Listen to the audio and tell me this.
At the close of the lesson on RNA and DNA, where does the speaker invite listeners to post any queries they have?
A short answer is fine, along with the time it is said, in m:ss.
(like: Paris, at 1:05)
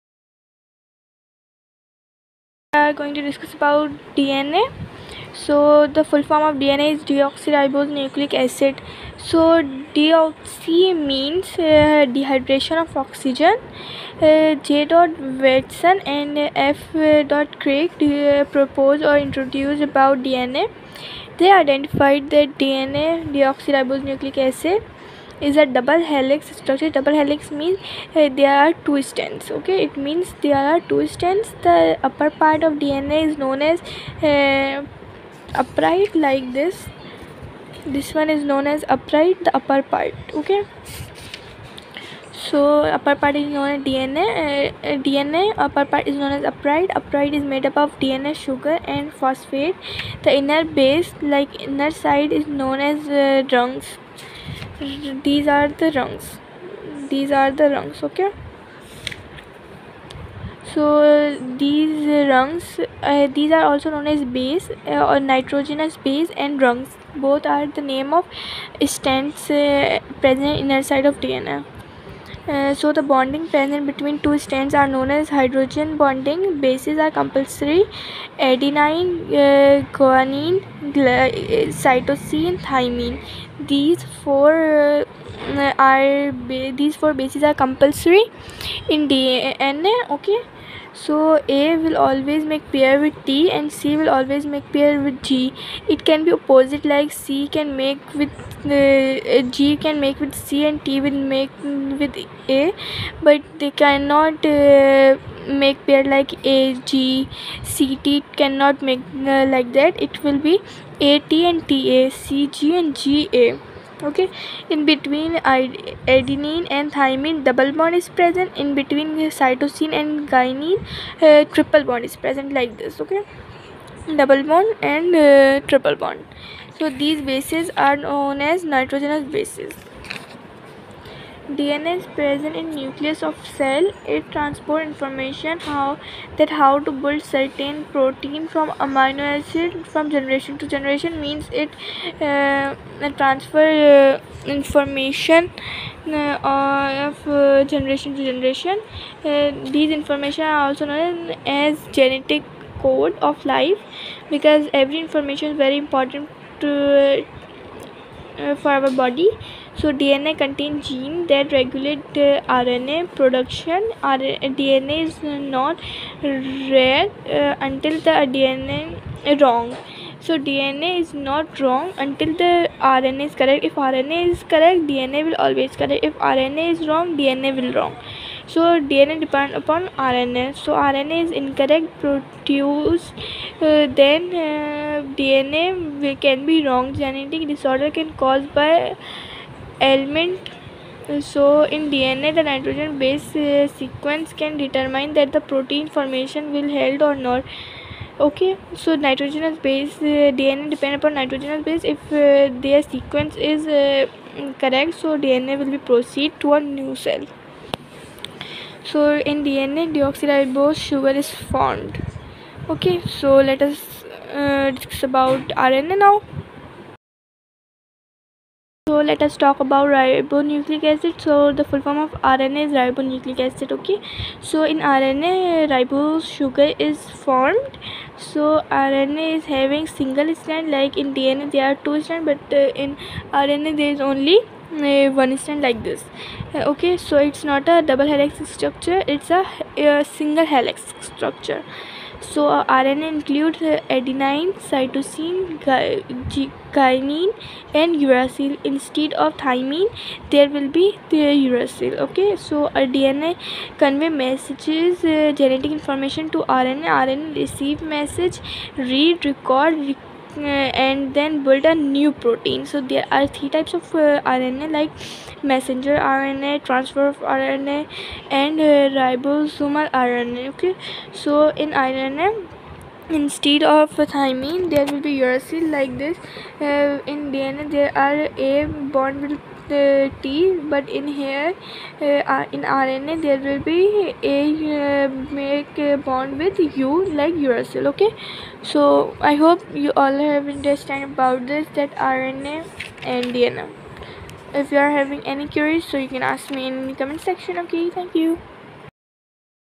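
Comment section, at 4:56.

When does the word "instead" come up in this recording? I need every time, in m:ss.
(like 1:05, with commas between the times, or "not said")
4:08, 4:33.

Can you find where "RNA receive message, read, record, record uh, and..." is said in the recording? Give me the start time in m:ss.
4:16.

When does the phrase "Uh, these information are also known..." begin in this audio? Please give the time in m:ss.
2:29.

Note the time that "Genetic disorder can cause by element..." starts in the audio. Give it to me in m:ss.
3:06.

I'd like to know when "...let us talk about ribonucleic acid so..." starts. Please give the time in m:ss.
3:39.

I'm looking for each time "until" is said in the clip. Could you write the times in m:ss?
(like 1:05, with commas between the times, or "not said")
2:47, 2:51.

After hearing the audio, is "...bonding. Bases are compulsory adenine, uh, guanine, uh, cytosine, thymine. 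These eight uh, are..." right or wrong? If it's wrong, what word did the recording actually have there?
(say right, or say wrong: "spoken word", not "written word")
wrong: "four", not "eight".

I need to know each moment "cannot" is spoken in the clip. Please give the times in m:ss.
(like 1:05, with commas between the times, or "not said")
1:43, 1:48.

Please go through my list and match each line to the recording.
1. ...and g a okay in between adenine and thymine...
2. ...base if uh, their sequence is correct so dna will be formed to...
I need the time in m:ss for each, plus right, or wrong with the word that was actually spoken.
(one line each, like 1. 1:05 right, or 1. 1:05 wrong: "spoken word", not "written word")
1. 1:52 right
2. 3:21 wrong: "proceed", not "formed".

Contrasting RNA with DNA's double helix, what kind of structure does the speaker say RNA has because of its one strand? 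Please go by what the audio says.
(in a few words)
Single helix structure.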